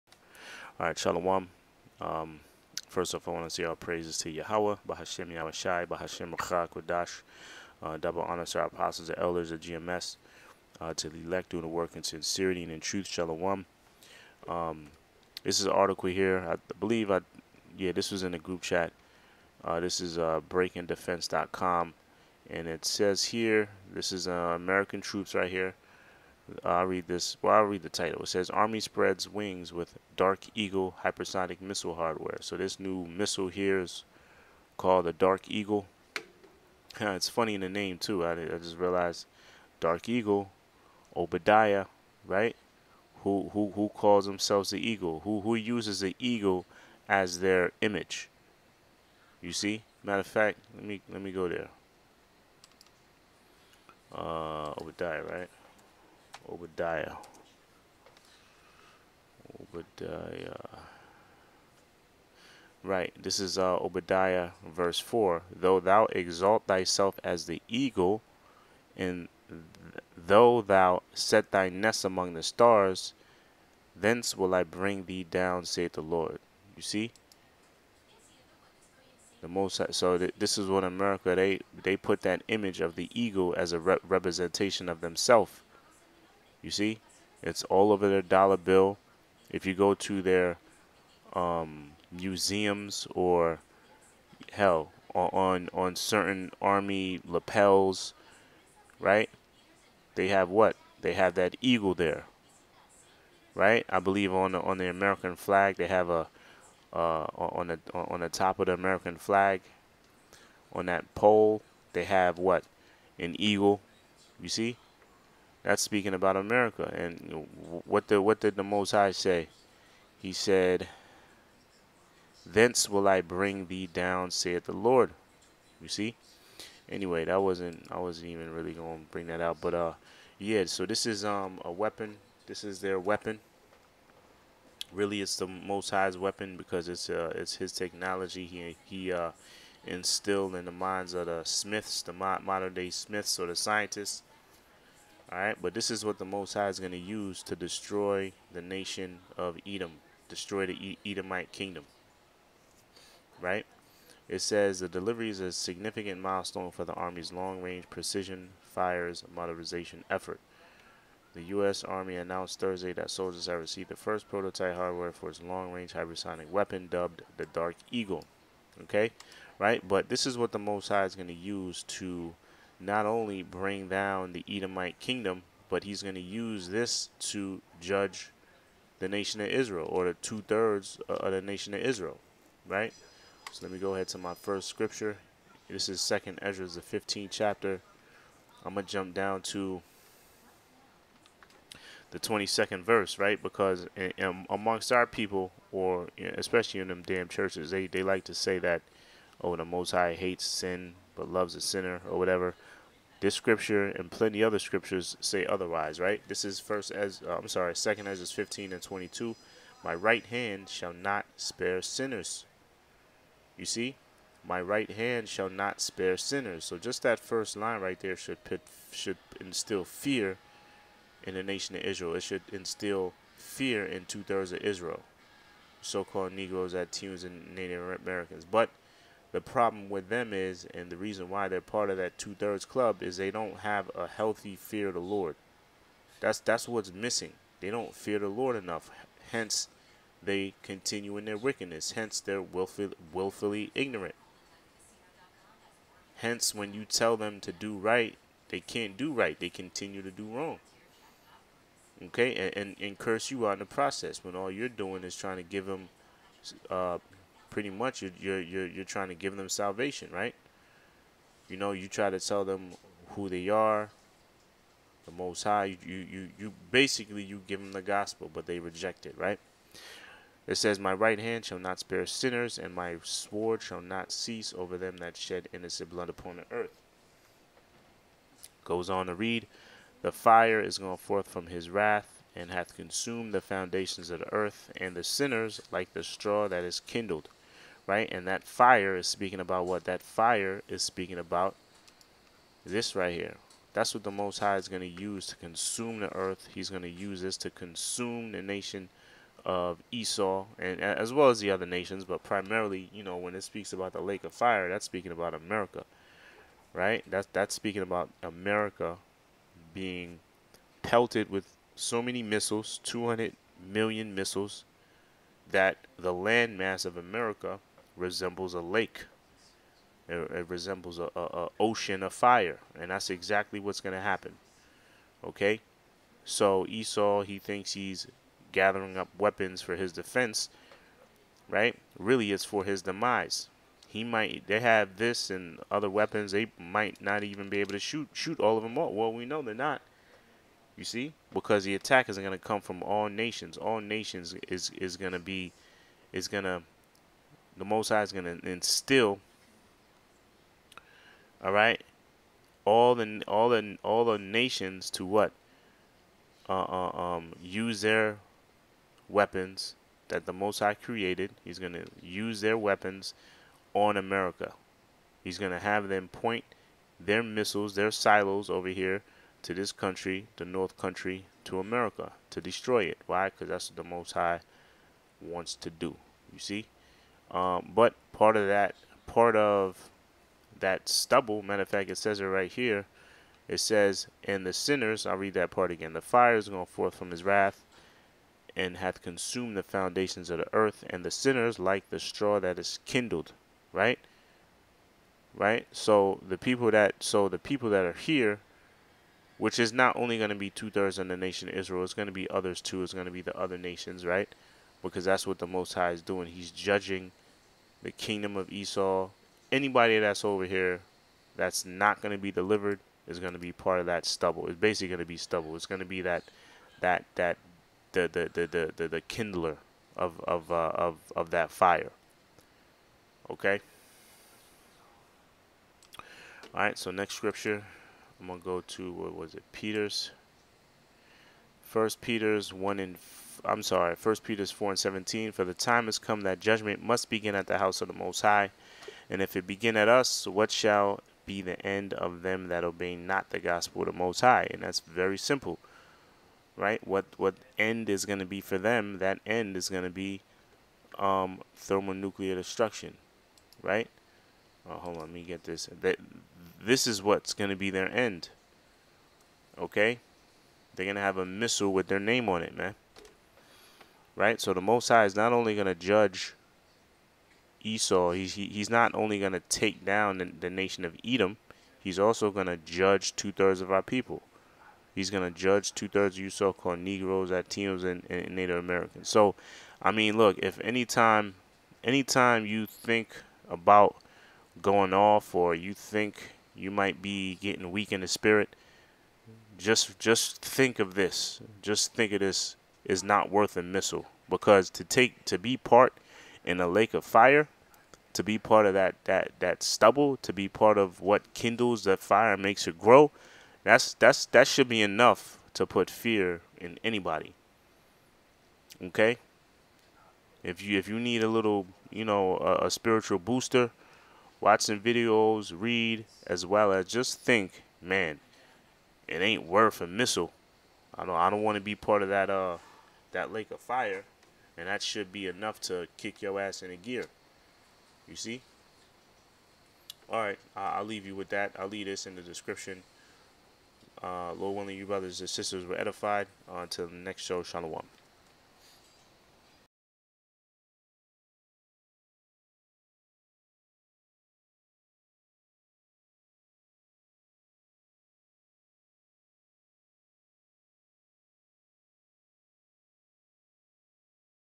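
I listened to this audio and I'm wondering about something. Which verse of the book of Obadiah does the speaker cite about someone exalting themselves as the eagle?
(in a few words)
Verse 4.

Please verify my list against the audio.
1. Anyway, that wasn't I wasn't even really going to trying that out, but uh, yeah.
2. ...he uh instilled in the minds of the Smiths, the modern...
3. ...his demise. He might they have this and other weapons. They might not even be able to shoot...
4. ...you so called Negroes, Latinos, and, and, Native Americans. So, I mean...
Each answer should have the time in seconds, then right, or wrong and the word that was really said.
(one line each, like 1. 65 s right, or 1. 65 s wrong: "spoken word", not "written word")
1. 126 s wrong: "bring", not "trying"
2. 138 s right
3. 332 s right
4. 476 s right.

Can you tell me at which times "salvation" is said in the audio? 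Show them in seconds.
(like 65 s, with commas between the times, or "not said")
259 s.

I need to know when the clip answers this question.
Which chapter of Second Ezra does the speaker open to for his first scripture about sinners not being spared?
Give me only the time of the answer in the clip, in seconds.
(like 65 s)
186 s.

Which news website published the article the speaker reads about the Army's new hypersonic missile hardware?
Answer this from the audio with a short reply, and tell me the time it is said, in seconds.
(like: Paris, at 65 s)
breakingdefense.com, at 20 s.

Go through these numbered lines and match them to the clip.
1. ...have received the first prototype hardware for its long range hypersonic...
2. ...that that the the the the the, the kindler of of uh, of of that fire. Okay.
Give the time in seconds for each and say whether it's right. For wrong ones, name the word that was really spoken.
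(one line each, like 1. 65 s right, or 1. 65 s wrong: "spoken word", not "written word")
1. 163 s right
2. 416 s right.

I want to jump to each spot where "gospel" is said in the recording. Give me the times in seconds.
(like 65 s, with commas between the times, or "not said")
267 s, 443 s.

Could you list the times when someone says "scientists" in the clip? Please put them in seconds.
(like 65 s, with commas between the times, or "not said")
143 s.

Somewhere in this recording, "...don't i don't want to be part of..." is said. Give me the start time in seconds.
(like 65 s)
521 s.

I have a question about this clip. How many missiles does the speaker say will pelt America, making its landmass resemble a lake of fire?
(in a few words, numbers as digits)
200 million.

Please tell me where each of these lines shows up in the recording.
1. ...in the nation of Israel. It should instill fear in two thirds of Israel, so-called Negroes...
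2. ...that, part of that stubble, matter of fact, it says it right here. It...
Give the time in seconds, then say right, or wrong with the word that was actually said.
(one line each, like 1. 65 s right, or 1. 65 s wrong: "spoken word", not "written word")
1. 221 s right
2. 378 s right.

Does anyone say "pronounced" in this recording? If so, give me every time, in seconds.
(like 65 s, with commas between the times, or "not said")
not said.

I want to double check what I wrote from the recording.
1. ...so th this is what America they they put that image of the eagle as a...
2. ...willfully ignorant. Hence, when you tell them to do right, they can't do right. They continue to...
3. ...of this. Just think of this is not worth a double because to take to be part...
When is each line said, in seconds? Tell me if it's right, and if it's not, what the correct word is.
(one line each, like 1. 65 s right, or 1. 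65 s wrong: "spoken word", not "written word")
1. 79 s right
2. 243 s right
3. 490 s wrong: "missile", not "double".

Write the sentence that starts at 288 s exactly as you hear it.
And that fire is speaking about what?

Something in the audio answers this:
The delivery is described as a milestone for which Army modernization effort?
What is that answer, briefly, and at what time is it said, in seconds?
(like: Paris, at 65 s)
Long range precision fires, at 157 s.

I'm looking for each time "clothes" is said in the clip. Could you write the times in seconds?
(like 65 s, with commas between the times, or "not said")
not said.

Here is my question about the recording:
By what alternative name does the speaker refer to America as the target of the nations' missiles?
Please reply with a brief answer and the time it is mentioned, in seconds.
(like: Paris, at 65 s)
The North Country, at 370 s.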